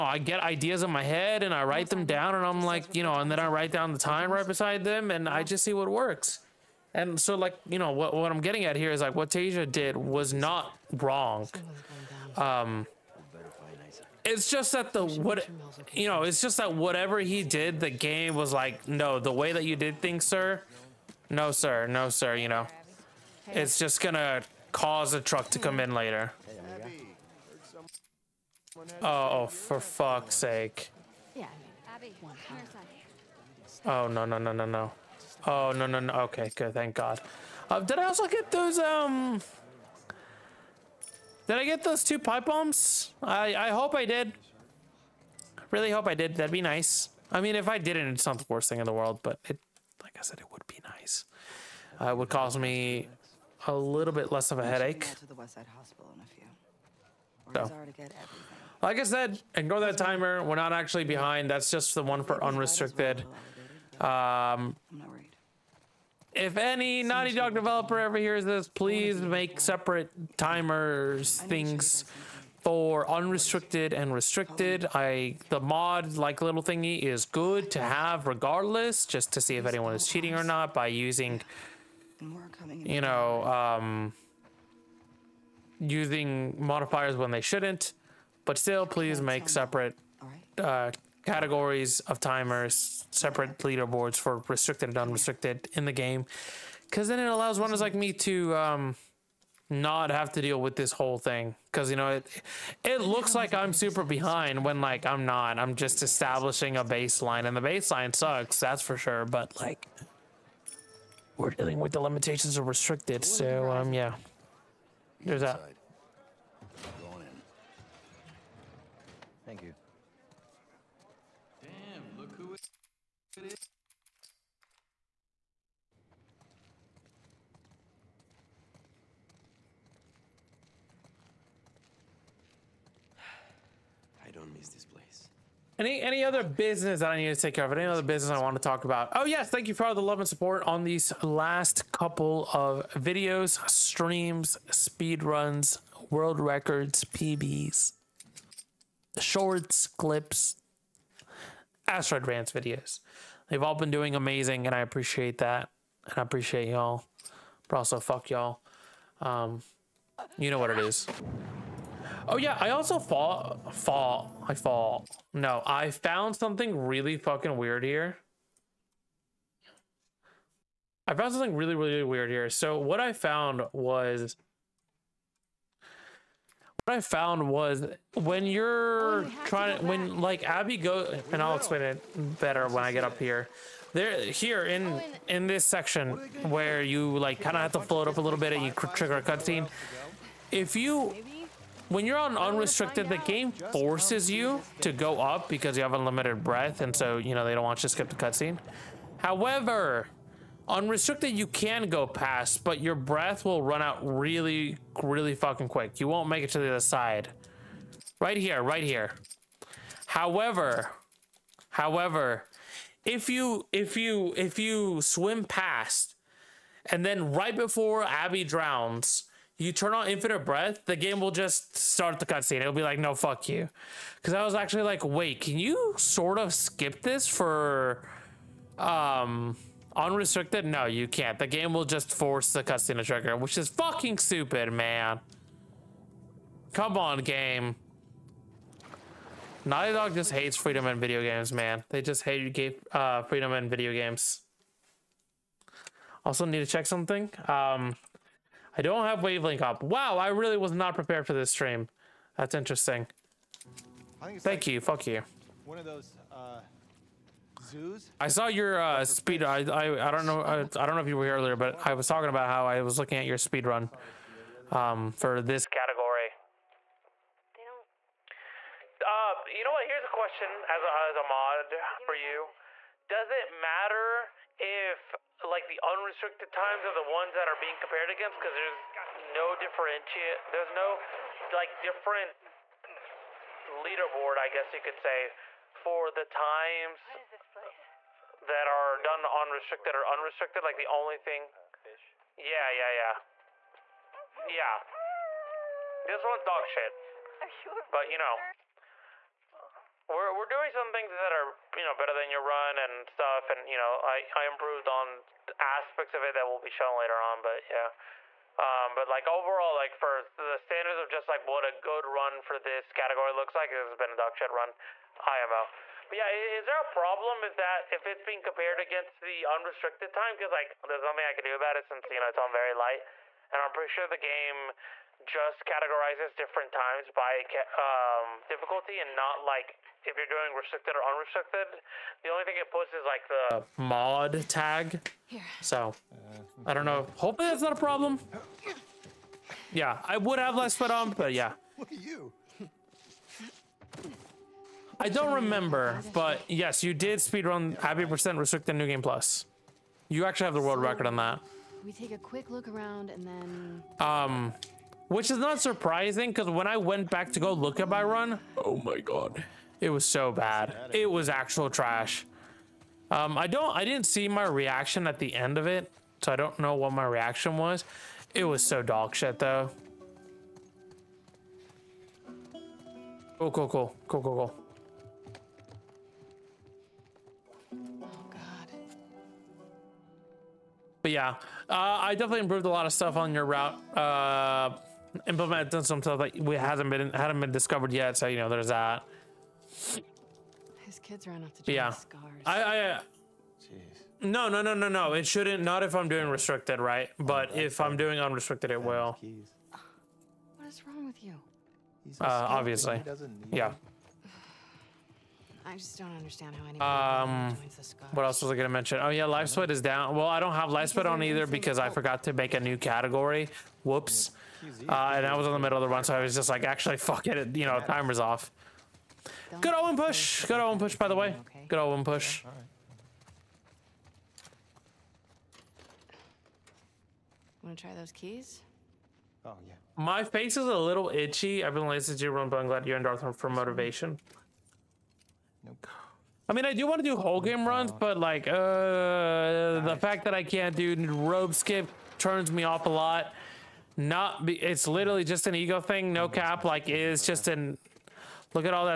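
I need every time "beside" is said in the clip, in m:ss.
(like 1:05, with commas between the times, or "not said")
0:04.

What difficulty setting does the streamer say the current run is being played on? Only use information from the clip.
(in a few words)
Very light.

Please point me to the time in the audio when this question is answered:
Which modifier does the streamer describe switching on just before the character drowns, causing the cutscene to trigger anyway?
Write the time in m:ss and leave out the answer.
3:40.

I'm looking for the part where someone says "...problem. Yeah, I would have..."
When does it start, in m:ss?
5:37.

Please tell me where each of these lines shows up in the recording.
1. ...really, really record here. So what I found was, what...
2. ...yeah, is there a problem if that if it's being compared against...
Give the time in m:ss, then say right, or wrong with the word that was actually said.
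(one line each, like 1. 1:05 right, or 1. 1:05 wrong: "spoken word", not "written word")
1. 2:51 wrong: "weird", not "record"
2. 5:16 right.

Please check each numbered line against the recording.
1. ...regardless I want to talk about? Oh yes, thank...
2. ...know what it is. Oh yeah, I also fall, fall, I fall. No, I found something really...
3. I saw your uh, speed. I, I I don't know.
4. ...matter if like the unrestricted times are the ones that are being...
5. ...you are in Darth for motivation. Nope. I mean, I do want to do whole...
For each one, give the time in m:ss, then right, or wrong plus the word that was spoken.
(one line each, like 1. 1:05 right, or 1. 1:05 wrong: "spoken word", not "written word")
1. 2:18 wrong: "business", not "regardless"
2. 2:40 right
3. 4:18 right
4. 4:33 right
5. 7:12 right.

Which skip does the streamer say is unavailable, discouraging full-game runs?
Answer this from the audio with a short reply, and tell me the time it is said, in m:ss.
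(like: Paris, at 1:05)
Rope skip, at 7:21.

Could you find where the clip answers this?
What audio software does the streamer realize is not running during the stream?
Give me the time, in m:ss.
4:09.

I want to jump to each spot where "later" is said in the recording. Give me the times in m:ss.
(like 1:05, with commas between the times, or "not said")
0:25, 5:06.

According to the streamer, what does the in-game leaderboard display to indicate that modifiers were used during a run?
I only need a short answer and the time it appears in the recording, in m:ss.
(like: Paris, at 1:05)
The mod tag, at 5:33.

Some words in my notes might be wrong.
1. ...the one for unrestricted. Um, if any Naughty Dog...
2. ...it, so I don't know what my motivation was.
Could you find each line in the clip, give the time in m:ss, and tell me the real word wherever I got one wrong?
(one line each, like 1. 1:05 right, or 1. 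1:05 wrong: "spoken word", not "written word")
1. 1:01 right
2. 6:05 wrong: "reaction", not "motivation".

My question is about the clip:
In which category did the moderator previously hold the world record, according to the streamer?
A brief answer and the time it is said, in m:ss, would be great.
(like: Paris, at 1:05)
Abby Percent Restricted New Game Plus, at 5:47.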